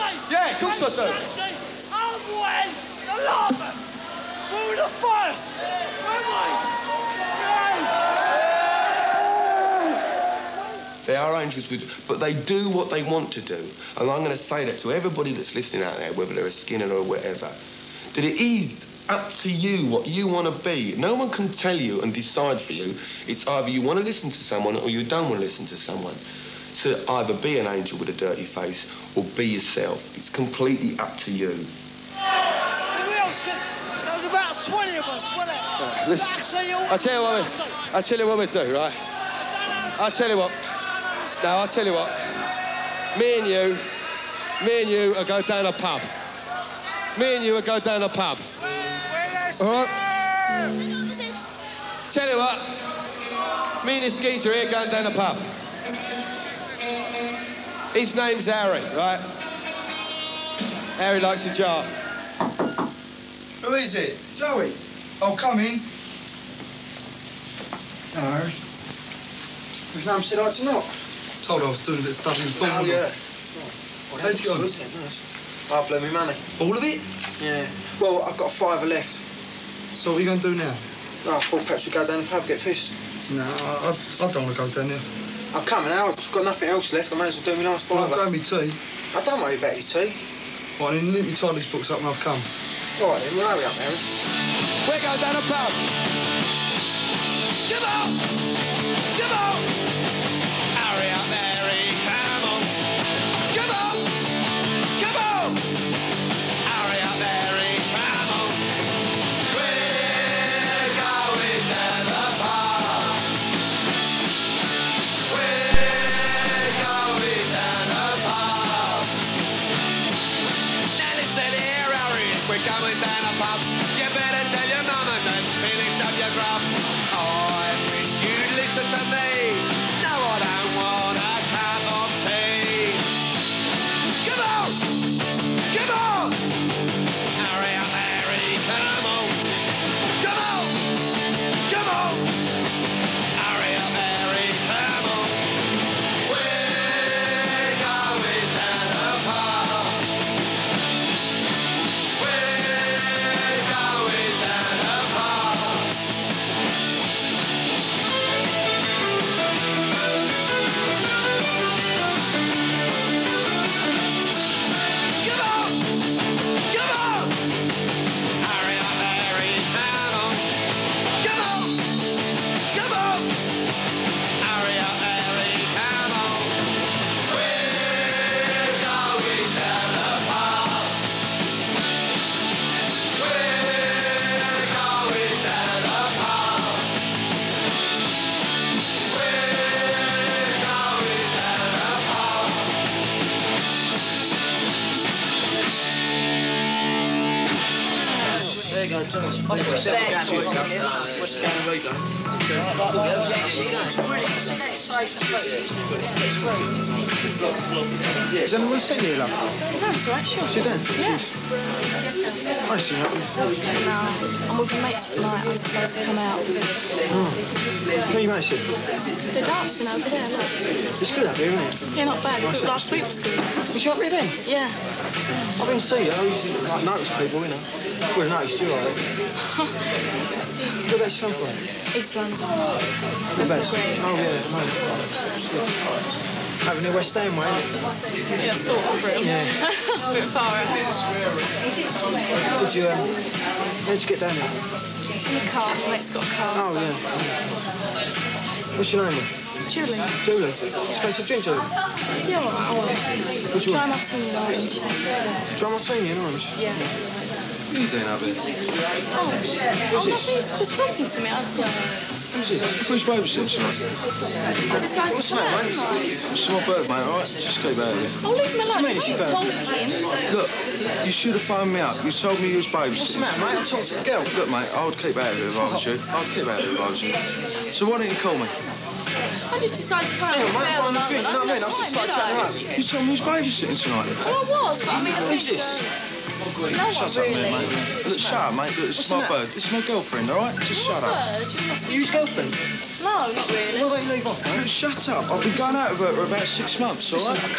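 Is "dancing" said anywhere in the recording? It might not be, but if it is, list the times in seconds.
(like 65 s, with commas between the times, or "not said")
219 s.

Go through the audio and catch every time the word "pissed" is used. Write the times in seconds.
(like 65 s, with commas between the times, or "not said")
82 s.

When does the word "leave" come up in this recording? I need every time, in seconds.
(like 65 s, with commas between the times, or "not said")
268 s, 294 s.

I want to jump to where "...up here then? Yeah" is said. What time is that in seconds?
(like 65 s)
223 s.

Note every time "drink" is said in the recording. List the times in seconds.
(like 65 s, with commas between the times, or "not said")
251 s.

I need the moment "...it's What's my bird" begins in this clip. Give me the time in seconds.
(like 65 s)
288 s.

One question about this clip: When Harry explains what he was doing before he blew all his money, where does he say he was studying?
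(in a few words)
Thornton.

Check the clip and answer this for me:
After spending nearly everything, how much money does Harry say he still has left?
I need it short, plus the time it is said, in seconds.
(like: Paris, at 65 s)
a fiver, at 78 s.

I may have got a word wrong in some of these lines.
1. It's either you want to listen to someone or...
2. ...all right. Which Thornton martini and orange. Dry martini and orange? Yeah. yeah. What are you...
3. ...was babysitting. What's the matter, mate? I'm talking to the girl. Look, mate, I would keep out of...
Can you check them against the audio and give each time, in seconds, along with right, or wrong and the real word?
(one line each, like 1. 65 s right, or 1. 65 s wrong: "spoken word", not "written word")
1. 23 s right
2. 252 s wrong: "Dry", not "Thornton"
3. 272 s right.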